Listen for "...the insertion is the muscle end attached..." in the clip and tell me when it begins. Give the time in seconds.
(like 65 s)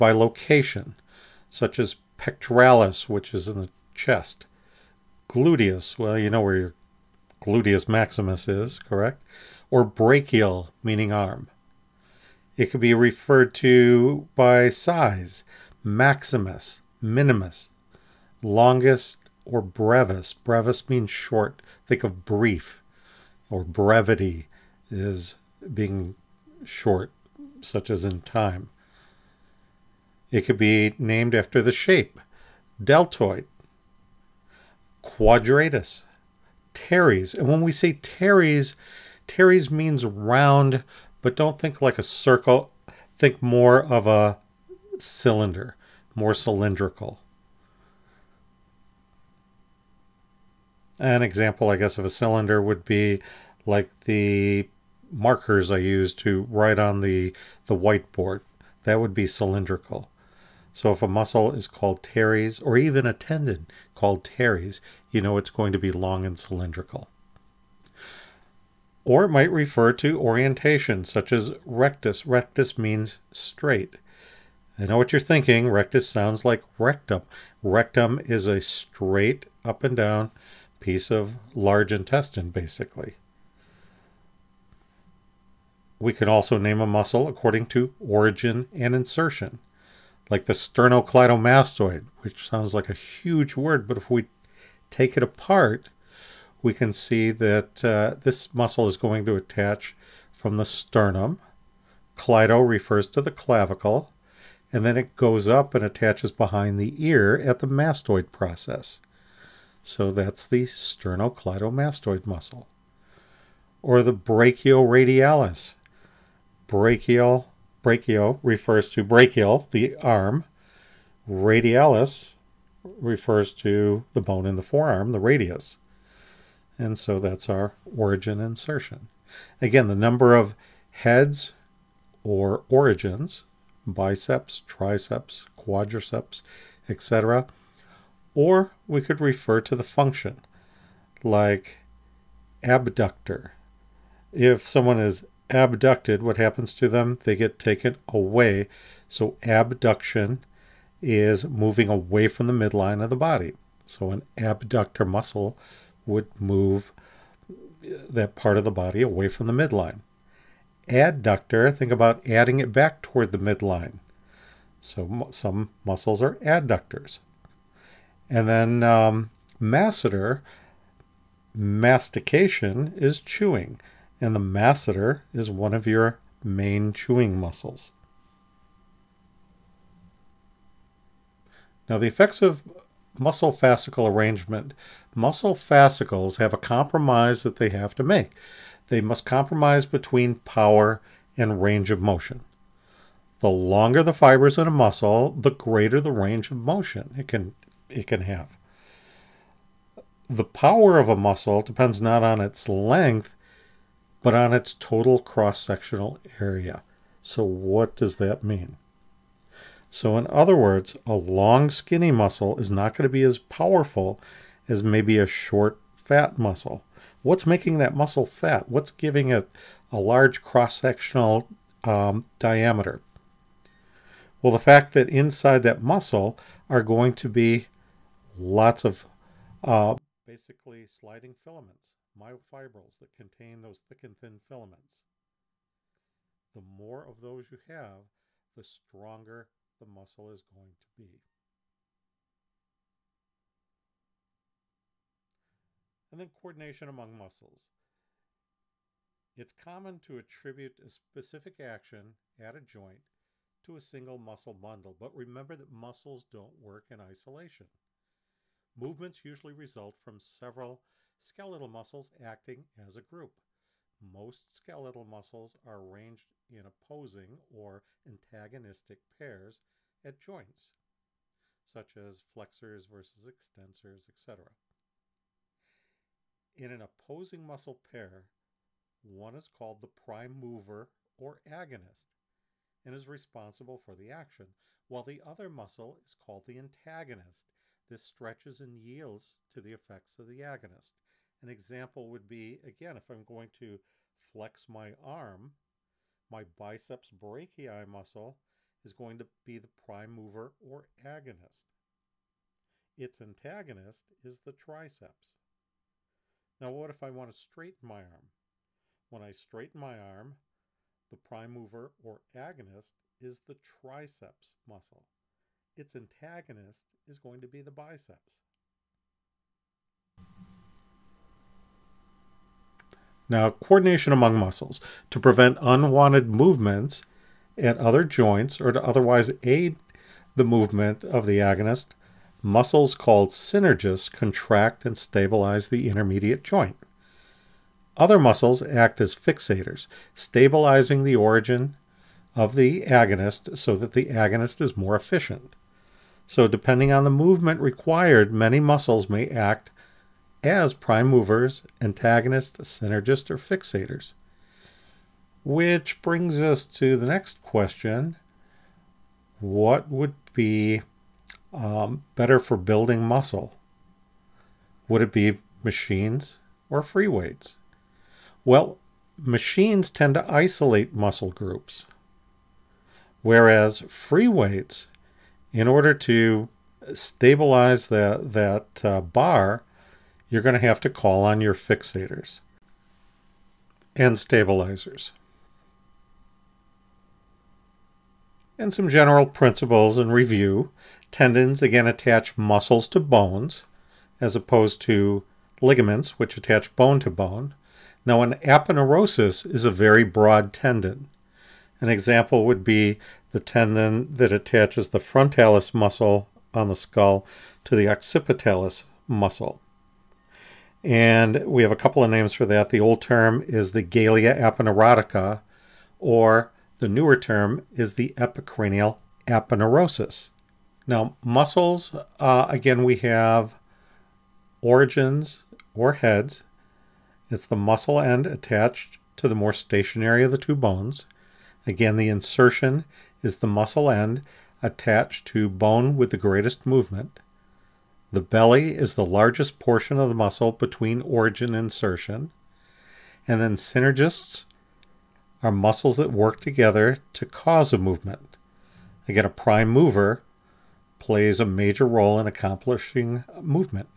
431 s.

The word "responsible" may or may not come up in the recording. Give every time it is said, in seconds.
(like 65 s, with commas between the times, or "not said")
283 s.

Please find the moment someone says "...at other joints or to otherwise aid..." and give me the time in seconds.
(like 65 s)
327 s.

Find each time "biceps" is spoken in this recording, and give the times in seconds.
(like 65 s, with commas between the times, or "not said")
133 s, 296 s, 317 s.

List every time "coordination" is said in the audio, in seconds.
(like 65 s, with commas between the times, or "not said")
246 s, 323 s.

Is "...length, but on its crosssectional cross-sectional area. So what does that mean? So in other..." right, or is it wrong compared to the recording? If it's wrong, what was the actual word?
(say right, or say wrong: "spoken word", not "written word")
wrong: "total", not "crosssectional".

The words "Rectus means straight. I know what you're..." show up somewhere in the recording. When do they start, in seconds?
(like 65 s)
72 s.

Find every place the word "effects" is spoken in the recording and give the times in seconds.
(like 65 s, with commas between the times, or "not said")
182 s, 289 s.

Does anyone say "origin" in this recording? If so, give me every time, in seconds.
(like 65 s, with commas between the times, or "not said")
88 s, 127 s, 132 s, 341 s, 424 s, 441 s.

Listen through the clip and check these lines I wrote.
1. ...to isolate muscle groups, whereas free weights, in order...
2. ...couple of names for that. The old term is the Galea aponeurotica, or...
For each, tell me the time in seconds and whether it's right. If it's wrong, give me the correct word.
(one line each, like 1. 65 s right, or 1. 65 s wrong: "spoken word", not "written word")
1. 370 s right
2. 411 s right.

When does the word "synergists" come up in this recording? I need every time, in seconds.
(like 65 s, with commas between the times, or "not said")
333 s, 352 s, 443 s.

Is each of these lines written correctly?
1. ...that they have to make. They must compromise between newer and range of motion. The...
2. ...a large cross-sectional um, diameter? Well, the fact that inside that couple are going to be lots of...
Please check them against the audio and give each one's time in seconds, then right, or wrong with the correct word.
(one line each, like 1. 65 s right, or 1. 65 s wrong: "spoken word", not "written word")
1. 187 s wrong: "power", not "newer"
2. 219 s wrong: "muscle", not "couple".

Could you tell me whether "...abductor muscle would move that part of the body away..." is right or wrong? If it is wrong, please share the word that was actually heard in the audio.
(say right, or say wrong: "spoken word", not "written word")
right.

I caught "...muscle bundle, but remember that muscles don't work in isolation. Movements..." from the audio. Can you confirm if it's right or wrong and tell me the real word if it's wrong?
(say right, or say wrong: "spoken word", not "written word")
right.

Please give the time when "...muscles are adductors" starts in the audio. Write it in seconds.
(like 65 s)
165 s.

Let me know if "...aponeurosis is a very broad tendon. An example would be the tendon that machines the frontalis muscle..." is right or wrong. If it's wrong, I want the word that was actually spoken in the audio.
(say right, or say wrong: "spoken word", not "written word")
wrong: "attaches", not "machines".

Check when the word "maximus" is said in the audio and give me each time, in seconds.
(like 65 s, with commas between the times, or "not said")
7 s, 15 s.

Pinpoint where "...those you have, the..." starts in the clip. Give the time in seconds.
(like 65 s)
237 s.